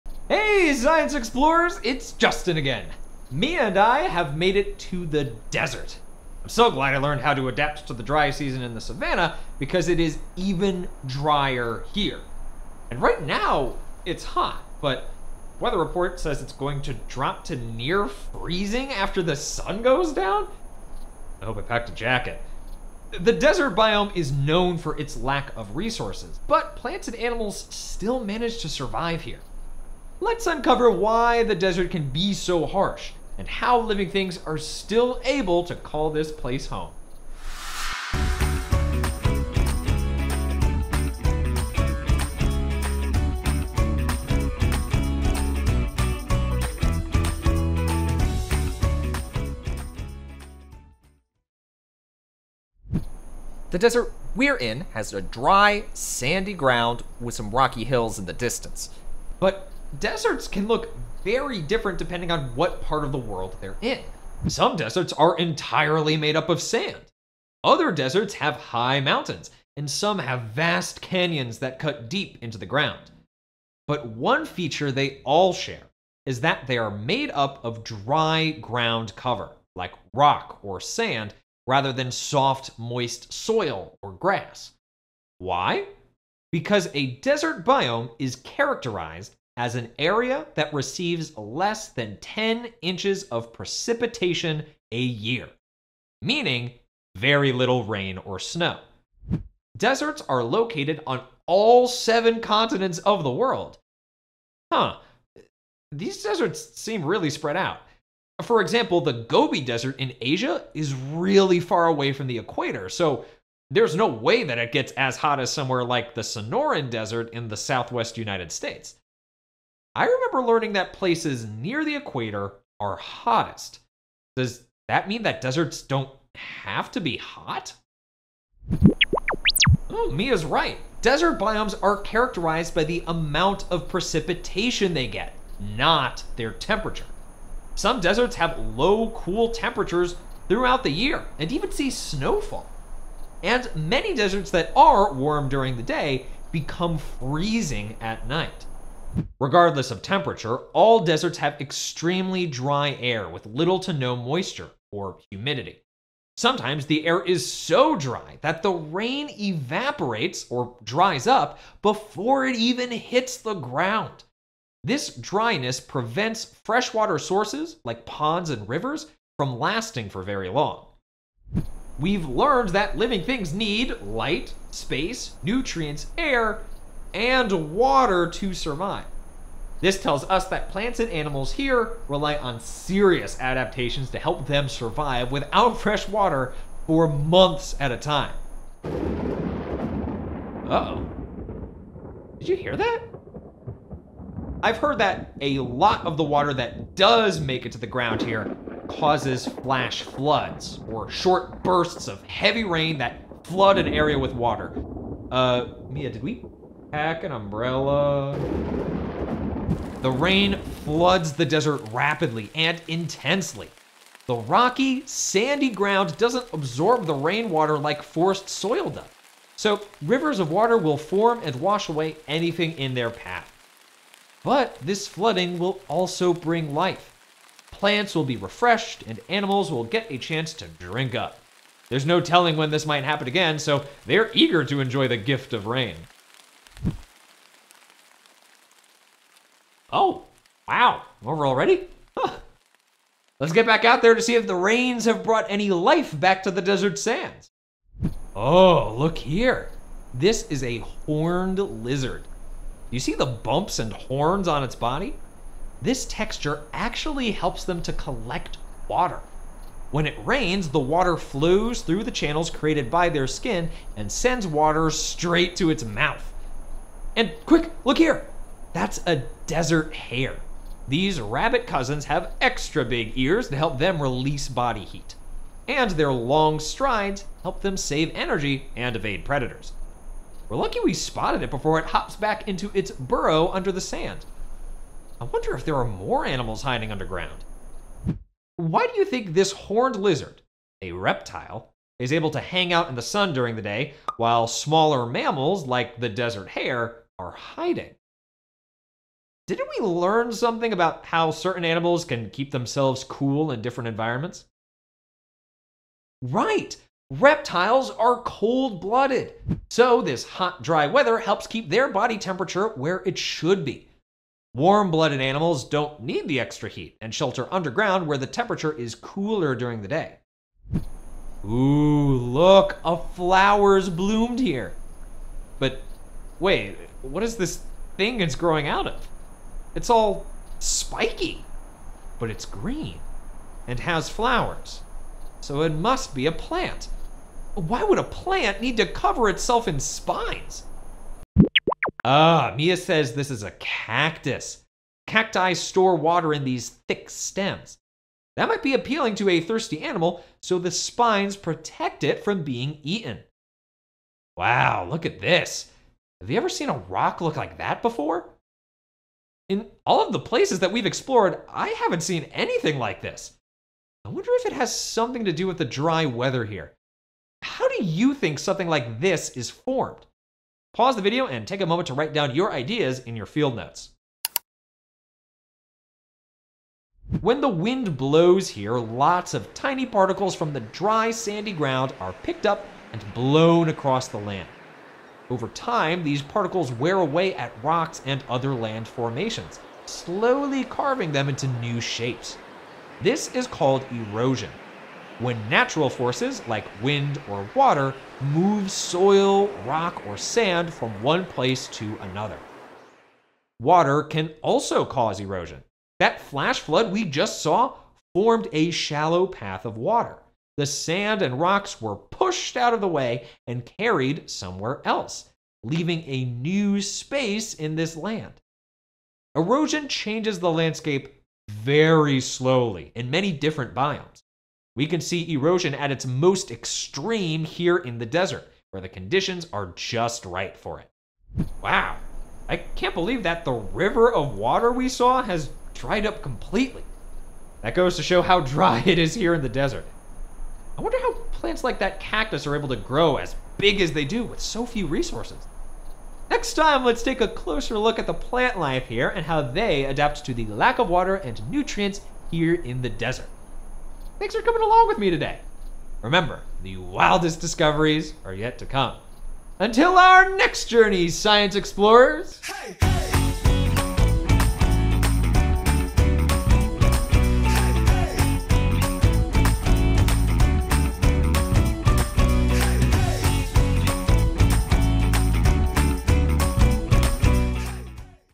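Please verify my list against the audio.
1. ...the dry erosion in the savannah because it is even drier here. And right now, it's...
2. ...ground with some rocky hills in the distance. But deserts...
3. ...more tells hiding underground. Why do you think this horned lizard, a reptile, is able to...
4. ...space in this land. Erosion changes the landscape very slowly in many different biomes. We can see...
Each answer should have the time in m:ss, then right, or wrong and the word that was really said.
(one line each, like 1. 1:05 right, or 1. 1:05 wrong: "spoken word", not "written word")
1. 0:07 wrong: "season", not "erosion"
2. 0:56 right
3. 4:45 wrong: "animals", not "tells"
4. 6:56 right.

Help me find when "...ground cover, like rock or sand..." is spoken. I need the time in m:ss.
1:18.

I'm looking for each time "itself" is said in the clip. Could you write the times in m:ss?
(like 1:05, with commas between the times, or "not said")
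5:39.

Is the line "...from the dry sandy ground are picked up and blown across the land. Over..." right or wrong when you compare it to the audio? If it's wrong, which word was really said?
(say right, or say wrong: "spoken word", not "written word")
right.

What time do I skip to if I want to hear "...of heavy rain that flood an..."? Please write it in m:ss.
3:22.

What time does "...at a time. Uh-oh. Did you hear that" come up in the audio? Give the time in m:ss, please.
3:07.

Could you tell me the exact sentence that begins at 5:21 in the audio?
Ooh, look, a flower's bloomed here.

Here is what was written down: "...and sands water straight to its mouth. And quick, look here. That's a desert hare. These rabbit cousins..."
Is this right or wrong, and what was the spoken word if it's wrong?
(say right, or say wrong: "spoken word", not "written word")
wrong: "sends", not "sands".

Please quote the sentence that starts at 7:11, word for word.
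Wow, I can't believe that the river of water we saw has dried up completely.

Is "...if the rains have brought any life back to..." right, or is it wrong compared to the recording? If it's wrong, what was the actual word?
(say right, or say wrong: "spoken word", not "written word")
right.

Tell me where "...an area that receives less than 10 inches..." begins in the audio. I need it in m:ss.
1:29.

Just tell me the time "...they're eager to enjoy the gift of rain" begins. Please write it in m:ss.
3:54.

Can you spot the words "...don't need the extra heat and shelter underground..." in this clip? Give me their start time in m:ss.
5:15.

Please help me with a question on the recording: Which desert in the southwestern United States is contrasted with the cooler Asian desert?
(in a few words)
Sonoran Desert.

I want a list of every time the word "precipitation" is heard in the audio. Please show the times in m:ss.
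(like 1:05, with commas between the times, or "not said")
1:33, 2:13.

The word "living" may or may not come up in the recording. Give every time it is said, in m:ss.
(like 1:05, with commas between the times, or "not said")
0:33, 2:52.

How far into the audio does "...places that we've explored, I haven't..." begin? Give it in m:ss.
6:00.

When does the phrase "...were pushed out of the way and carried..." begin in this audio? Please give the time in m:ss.
6:51.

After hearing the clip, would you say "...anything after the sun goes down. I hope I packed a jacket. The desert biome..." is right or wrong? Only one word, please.
wrong.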